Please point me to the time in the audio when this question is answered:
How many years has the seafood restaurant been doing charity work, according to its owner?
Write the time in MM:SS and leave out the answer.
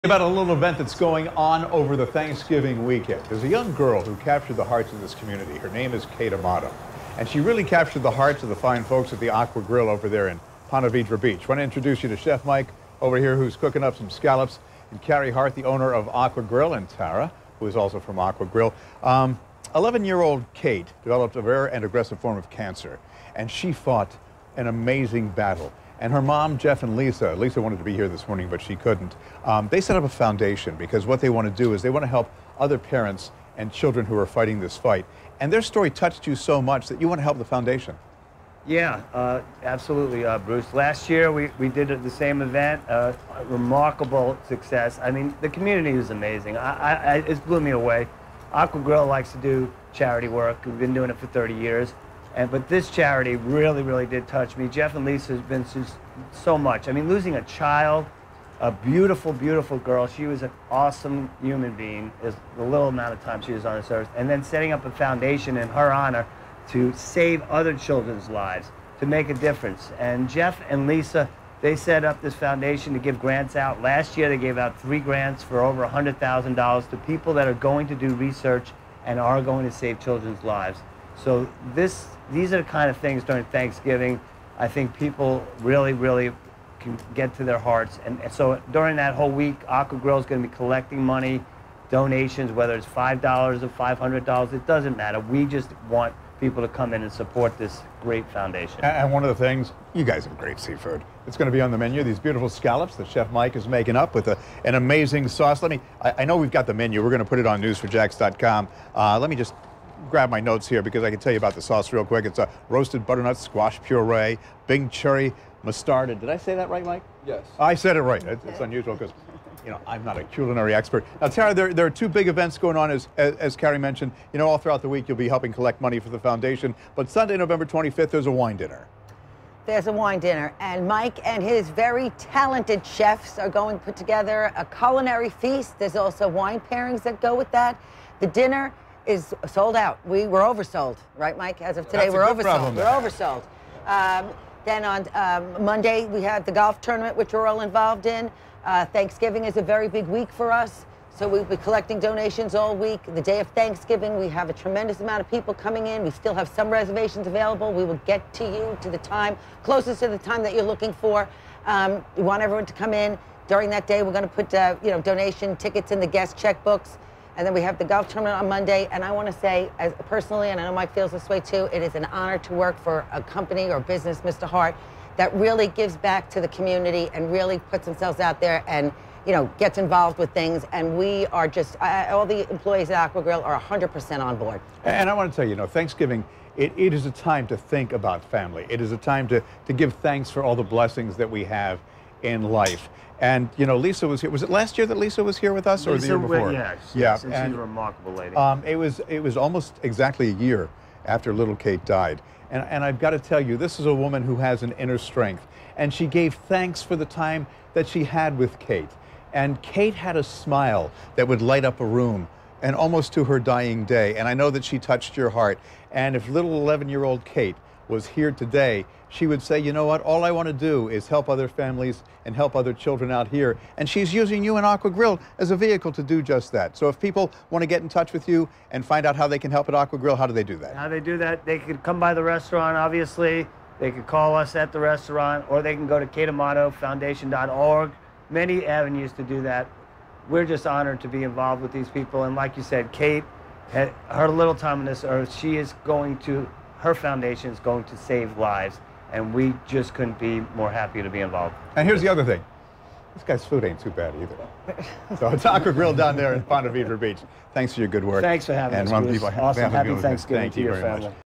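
00:51.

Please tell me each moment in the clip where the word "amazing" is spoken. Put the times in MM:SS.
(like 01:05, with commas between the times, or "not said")
00:24, 00:46, 01:44.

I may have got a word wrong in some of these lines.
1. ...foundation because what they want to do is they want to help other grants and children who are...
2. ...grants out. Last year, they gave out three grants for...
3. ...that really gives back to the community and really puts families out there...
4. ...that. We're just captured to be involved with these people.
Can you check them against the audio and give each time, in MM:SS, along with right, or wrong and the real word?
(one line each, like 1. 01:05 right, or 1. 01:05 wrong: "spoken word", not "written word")
1. 00:30 wrong: "parents", not "grants"
2. 01:13 right
3. 02:55 wrong: "themselves", not "families"
4. 03:59 wrong: "honored", not "captured".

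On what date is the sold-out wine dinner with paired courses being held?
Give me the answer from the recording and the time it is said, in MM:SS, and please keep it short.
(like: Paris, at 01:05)
Sunday, November 25th, at 02:07.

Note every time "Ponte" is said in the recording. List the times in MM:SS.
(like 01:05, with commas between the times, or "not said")
00:10, 04:16.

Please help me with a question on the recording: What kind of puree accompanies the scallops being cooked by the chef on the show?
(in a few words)
Roasted butternut squash.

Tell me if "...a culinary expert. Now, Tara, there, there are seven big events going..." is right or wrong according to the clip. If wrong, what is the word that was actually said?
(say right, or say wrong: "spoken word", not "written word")
wrong: "two", not "seven".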